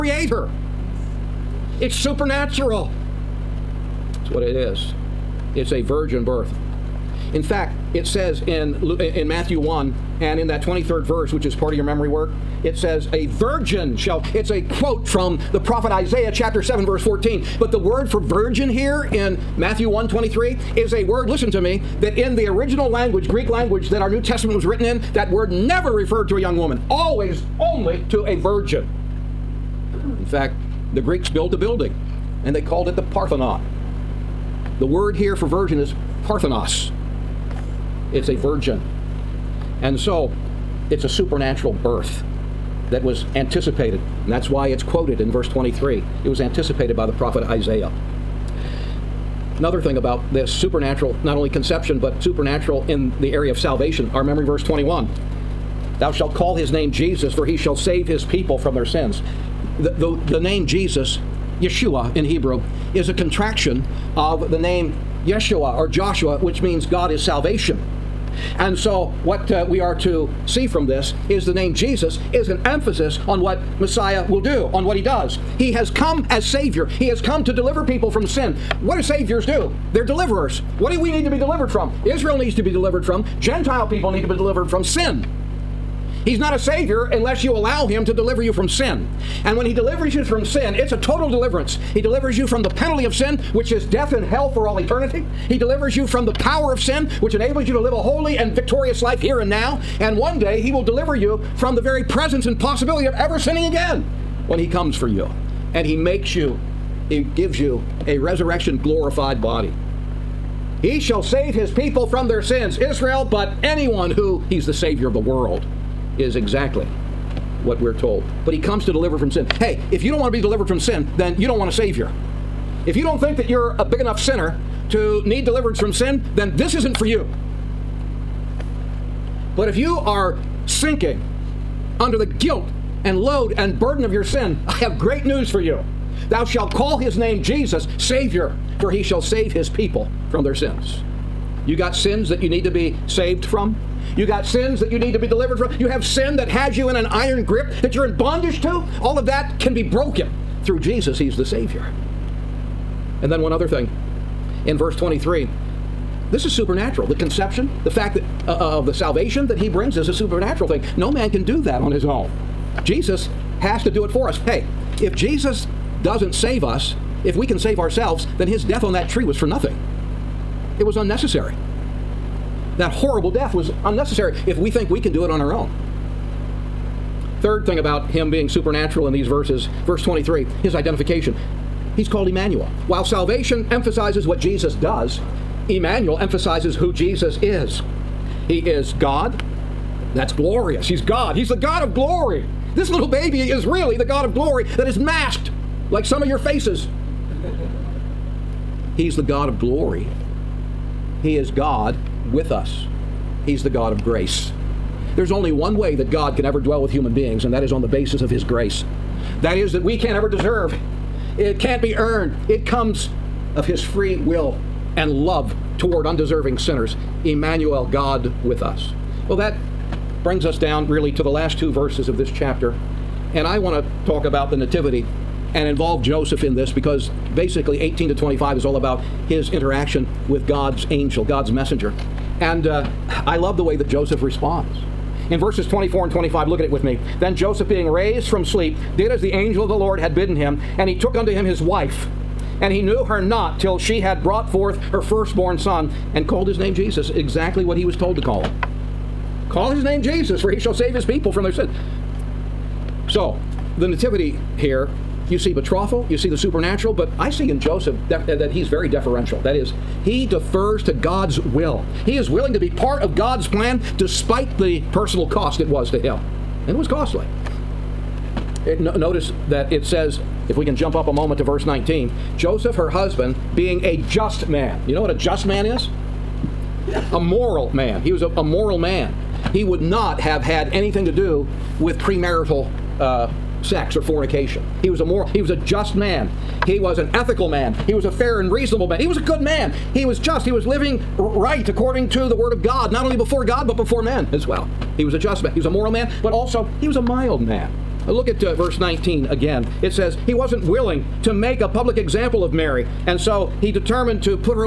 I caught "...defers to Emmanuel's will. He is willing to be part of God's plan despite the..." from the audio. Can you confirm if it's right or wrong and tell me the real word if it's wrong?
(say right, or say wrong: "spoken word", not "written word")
wrong: "God", not "Emmanuel".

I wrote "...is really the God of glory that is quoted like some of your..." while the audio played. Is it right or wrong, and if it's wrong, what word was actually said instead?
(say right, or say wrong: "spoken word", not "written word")
wrong: "masked", not "quoted".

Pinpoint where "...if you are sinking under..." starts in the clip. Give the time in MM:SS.
02:09.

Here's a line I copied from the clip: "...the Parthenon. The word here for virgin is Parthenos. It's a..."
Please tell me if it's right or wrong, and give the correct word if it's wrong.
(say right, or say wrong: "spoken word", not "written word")
right.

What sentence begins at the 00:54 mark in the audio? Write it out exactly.
Our memory verse 21 Thou shalt call his name Jesus, for he shall save his people from their sins.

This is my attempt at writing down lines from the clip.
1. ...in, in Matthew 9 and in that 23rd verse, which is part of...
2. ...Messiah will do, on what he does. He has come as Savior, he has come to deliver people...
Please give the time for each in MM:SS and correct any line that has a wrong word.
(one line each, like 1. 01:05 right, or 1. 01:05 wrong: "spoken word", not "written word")
1. 00:08 wrong: "1", not "9"
2. 01:13 right.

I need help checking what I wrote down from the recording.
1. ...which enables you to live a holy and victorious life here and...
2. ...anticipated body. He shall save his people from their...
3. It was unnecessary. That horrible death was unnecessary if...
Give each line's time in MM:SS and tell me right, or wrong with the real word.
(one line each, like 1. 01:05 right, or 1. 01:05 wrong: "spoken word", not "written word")
1. 01:37 right
2. 01:48 wrong: "glorified", not "anticipated"
3. 02:50 right.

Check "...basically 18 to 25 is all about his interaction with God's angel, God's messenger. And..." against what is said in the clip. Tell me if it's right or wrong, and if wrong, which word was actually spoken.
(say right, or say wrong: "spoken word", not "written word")
right.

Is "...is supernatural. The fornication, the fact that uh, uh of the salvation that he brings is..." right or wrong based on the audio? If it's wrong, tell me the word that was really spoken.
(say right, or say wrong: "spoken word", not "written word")
wrong: "conception", not "fornication".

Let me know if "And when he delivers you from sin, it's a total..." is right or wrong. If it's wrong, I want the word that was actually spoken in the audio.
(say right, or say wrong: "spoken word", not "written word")
right.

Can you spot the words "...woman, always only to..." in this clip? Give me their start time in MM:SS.
00:26.